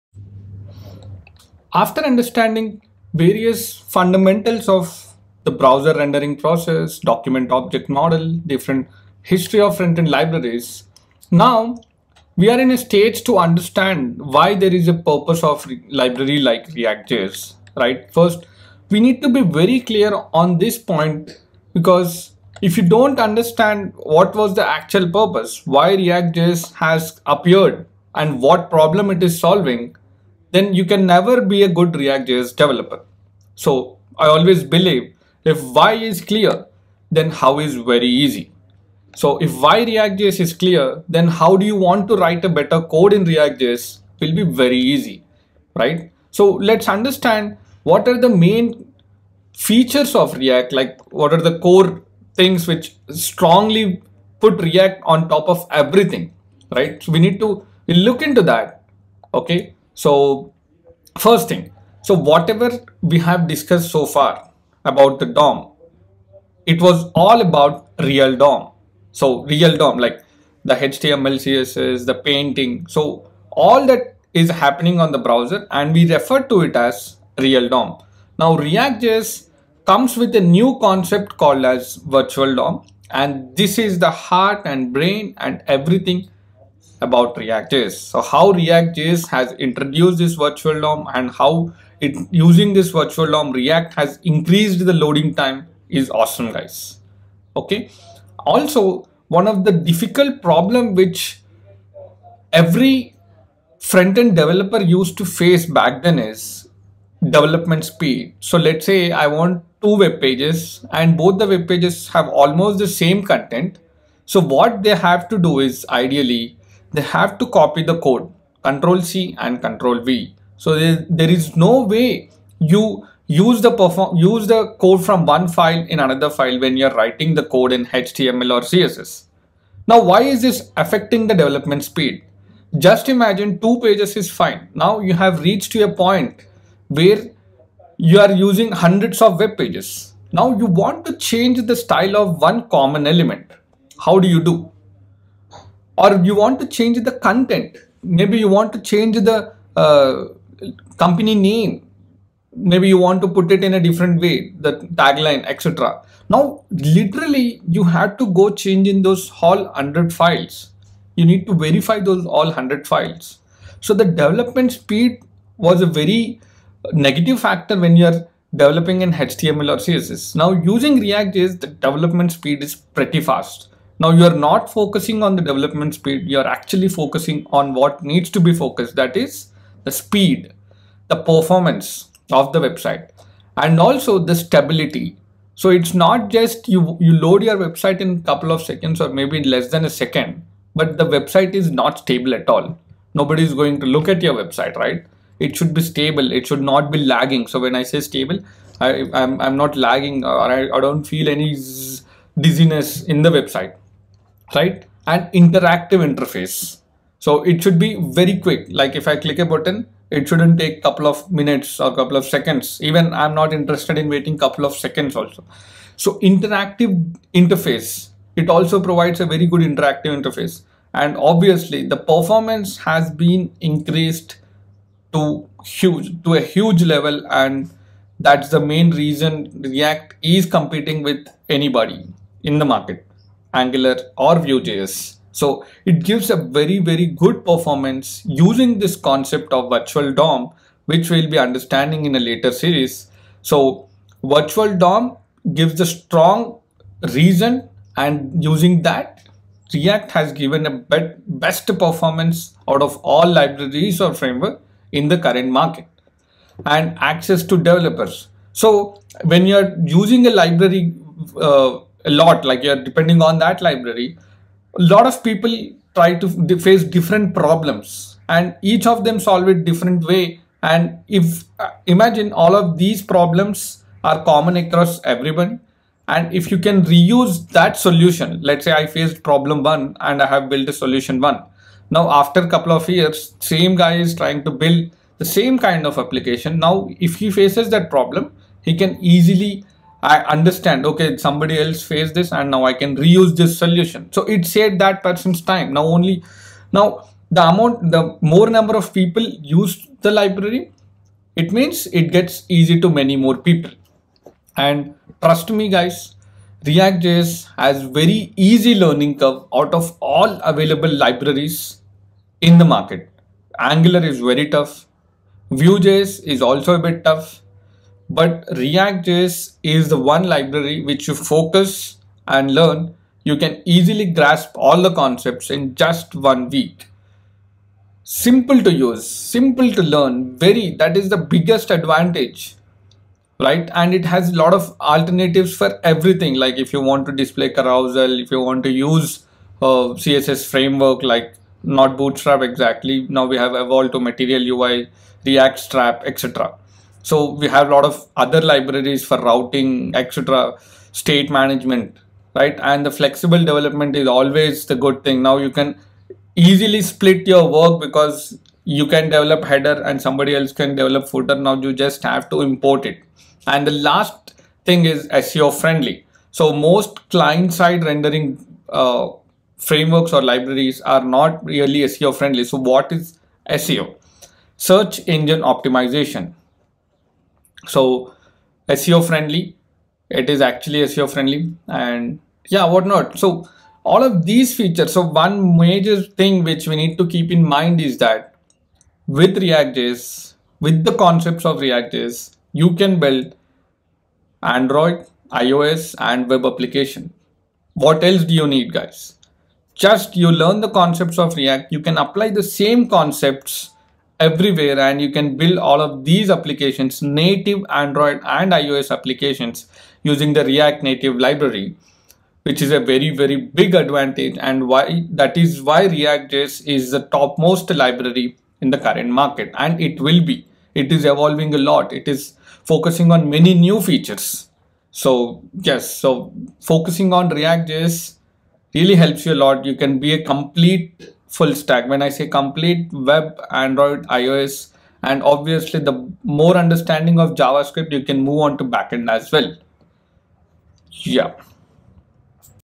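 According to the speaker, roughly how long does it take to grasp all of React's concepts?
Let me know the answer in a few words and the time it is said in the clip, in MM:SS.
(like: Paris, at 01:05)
One week, at 05:25.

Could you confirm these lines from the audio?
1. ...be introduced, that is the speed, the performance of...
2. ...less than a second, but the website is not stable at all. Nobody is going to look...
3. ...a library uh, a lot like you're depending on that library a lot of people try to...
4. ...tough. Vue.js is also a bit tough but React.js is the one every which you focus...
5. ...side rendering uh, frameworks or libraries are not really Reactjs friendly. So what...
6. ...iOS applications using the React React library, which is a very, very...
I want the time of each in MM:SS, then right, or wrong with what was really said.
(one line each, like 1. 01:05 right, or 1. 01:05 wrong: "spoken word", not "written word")
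1. 02:58 wrong: "focused", not "introduced"
2. 03:09 right
3. 04:20 right
4. 05:14 wrong: "library", not "every"
5. 06:07 wrong: "SEO", not "Reactjs"
6. 06:48 wrong: "Native", not "React".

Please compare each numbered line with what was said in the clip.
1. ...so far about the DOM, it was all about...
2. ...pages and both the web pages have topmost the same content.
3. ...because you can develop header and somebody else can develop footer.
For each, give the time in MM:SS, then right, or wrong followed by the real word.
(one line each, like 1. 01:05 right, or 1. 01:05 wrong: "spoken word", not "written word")
1. 01:03 right
2. 01:50 wrong: "almost", not "topmost"
3. 05:57 right.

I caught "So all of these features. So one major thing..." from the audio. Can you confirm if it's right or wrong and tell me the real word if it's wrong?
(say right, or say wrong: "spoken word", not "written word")
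right.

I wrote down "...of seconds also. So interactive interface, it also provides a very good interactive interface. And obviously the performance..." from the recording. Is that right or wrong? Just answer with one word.
right.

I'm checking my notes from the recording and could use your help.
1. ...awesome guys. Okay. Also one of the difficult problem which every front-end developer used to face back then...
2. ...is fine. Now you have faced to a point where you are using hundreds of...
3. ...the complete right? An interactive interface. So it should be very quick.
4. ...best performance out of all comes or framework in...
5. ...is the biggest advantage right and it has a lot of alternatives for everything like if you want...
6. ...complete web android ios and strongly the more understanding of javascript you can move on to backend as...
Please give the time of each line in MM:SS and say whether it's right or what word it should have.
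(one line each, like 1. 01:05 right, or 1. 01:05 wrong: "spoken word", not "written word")
1. 01:36 right
2. 02:14 wrong: "reached", not "faced"
3. 03:23 wrong: "website", not "complete"
4. 04:11 wrong: "libraries", not "comes"
5. 05:30 right
6. 07:12 wrong: "obviously", not "strongly".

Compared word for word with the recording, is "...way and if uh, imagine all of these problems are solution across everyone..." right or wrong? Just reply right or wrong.
wrong.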